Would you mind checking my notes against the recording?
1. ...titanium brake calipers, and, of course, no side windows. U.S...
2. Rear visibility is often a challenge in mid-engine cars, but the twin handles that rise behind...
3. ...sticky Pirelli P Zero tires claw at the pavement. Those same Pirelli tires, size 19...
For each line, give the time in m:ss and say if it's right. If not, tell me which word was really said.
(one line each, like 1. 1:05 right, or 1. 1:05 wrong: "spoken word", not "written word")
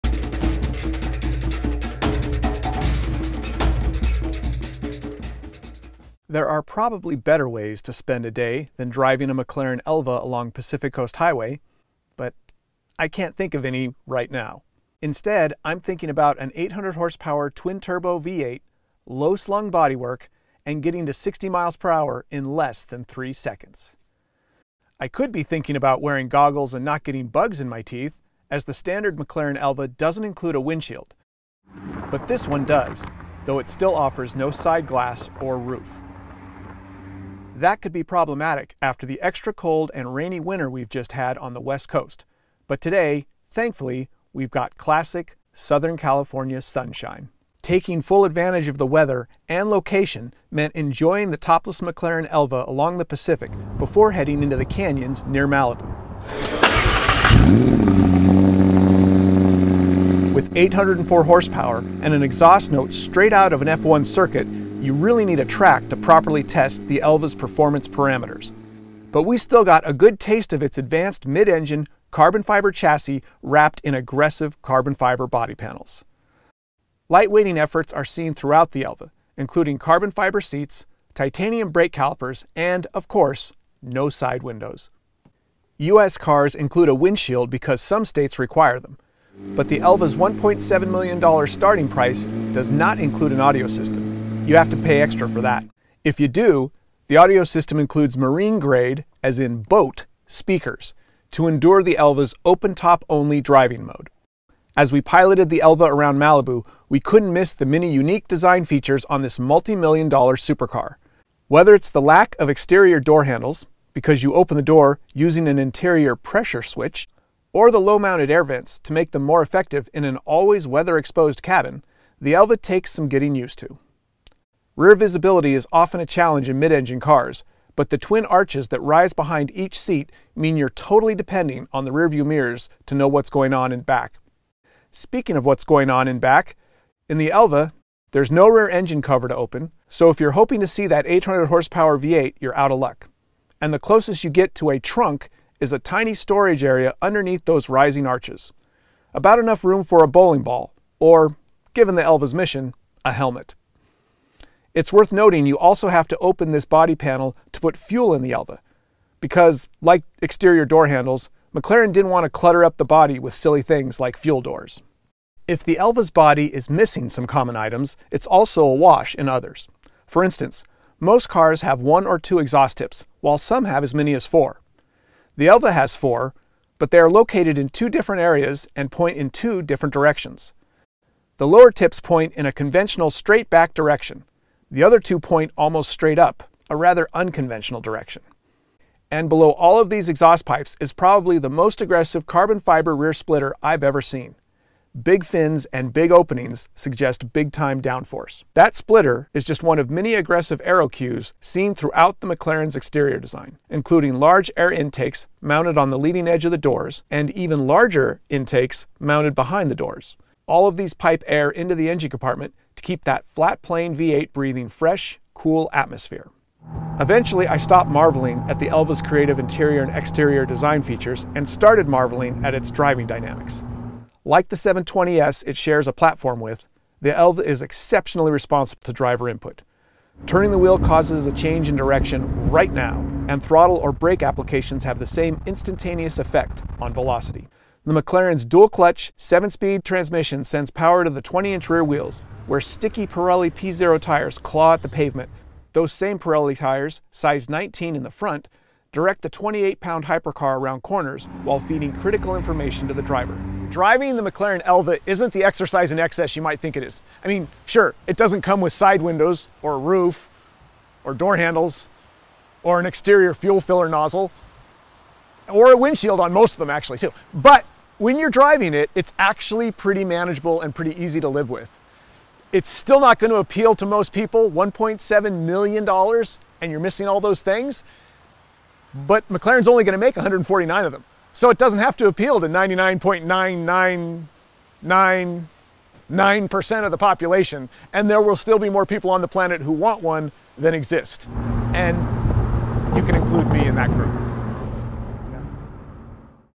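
1. 1:21 right
2. 2:04 wrong: "arches", not "handles"
3. 4:02 right.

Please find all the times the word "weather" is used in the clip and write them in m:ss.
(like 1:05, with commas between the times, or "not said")
0:48, 2:00.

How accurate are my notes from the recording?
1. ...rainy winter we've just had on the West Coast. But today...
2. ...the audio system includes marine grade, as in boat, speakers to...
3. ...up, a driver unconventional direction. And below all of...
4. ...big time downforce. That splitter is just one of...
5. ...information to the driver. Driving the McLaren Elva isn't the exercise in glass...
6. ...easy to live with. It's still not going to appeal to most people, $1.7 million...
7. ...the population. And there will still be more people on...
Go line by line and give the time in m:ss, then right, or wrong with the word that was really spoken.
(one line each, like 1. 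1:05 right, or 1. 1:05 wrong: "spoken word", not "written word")
1. 0:40 right
2. 1:37 right
3. 3:06 wrong: "rather", not "driver"
4. 3:17 right
5. 4:12 wrong: "excess", not "glass"
6. 4:31 right
7. 4:46 right.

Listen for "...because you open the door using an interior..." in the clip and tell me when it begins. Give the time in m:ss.
1:53.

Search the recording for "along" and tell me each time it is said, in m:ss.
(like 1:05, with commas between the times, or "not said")
0:10, 0:52.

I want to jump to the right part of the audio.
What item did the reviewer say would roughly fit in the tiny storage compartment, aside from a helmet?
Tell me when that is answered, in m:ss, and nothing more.
2:30.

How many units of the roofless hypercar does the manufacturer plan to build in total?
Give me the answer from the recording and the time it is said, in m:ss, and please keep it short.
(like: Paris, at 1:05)
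149, at 4:40.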